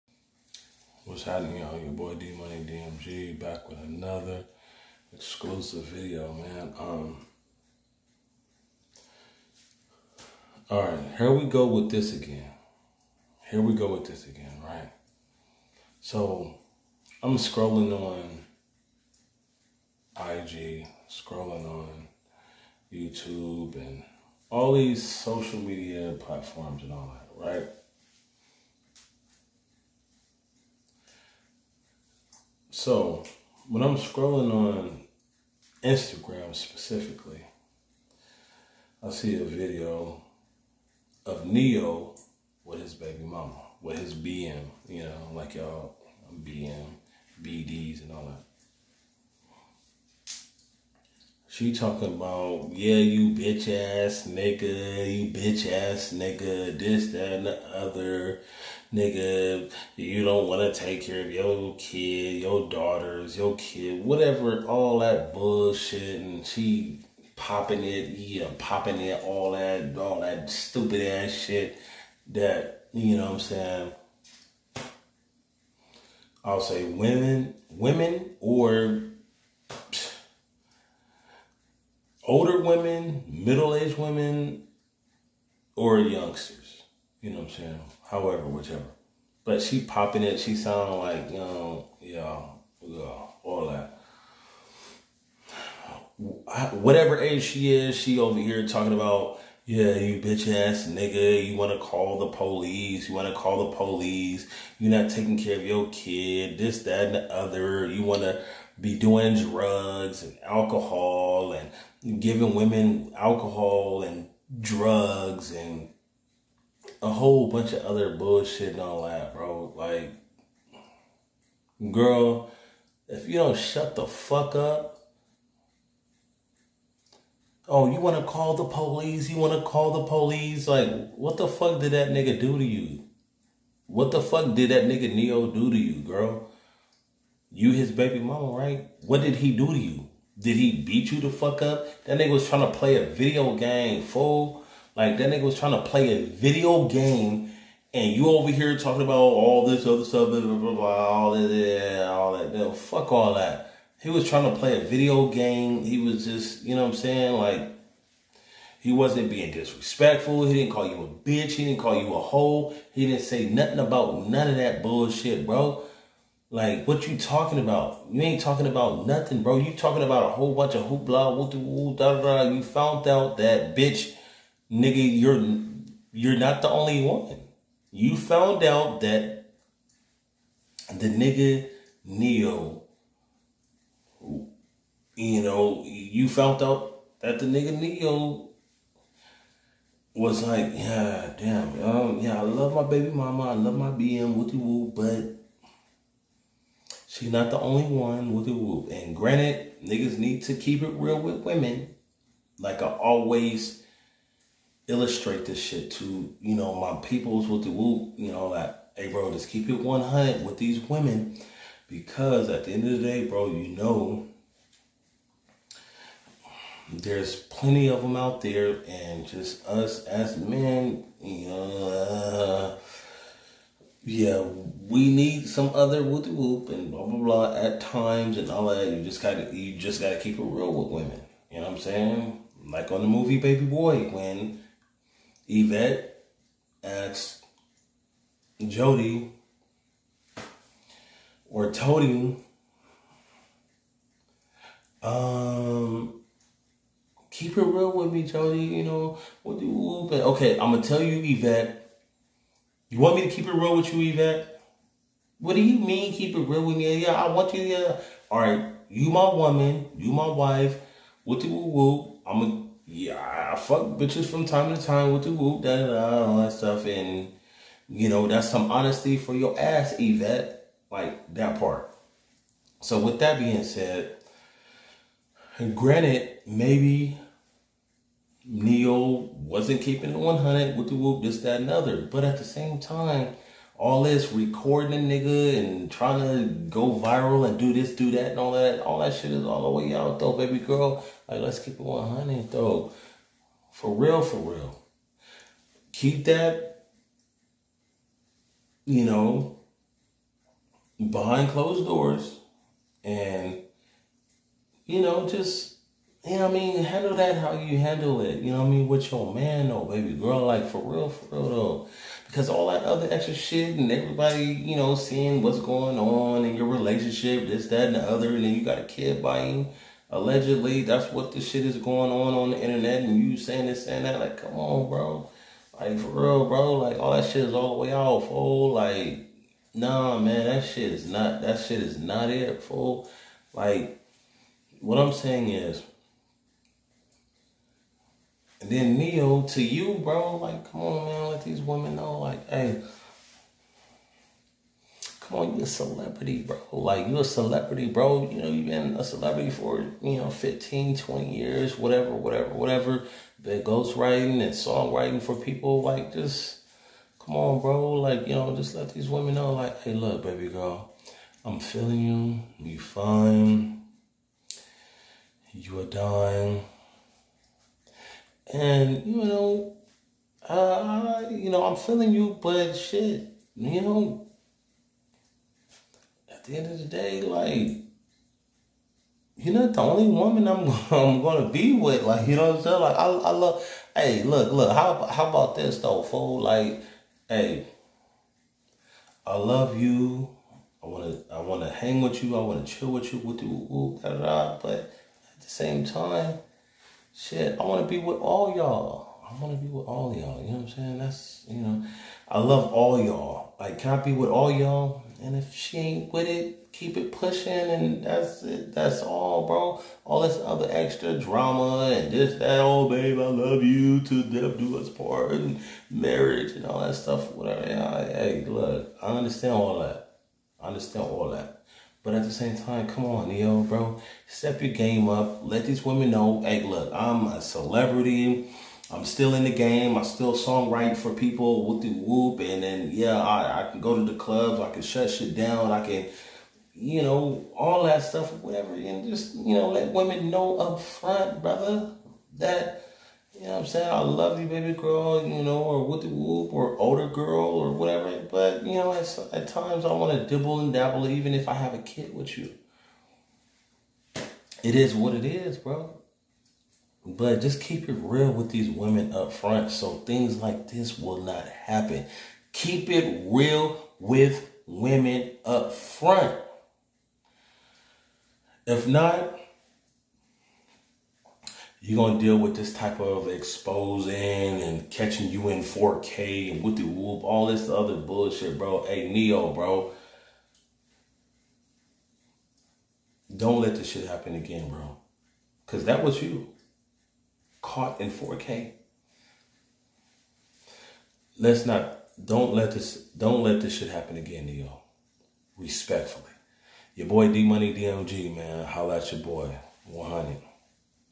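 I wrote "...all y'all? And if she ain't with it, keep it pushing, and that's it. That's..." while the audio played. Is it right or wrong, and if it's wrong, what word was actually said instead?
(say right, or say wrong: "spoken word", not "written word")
right.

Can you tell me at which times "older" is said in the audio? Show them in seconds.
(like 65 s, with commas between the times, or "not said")
82 s, 446 s.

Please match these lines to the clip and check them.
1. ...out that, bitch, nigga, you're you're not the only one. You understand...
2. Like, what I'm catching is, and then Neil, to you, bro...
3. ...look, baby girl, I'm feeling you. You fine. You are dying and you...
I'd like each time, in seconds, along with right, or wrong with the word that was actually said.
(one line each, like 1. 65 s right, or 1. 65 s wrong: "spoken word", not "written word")
1. 173 s wrong: "found", not "understand"
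2. 333 s wrong: "saying", not "catching"
3. 359 s right.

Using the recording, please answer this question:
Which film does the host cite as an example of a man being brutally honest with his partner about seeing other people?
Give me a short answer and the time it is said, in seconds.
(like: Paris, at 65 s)
Baby Boy, at 233 s.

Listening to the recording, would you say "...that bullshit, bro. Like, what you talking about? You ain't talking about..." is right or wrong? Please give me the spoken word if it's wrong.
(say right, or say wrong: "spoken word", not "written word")
right.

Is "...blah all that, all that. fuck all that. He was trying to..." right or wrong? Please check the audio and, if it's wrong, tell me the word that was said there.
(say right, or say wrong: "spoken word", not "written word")
right.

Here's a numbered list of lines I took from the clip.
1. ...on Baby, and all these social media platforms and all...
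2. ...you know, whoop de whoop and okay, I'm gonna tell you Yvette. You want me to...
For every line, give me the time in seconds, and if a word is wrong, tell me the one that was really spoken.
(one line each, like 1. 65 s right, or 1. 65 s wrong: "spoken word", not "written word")
1. 21 s wrong: "YouTube", not "Baby"
2. 248 s right.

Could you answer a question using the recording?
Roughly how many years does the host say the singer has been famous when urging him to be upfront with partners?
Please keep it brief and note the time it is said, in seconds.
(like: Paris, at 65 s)
15, 20 years, at 350 s.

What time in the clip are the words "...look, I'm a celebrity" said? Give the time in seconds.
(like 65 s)
426 s.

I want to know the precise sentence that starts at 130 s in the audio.
Like, what the fuck did that nigga do to you?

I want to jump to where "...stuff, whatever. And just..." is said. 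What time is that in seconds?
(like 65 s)
438 s.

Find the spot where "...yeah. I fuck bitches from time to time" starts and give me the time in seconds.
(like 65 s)
262 s.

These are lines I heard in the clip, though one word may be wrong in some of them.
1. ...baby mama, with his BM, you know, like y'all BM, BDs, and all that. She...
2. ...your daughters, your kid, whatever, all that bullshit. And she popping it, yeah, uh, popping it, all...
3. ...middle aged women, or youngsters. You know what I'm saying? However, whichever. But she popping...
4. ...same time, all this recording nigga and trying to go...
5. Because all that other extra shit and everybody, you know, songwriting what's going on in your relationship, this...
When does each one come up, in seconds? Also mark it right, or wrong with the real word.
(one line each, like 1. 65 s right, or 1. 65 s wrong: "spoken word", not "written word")
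1. 42 s right
2. 62 s right
3. 83 s right
4. 282 s right
5. 312 s wrong: "seeing", not "songwriting".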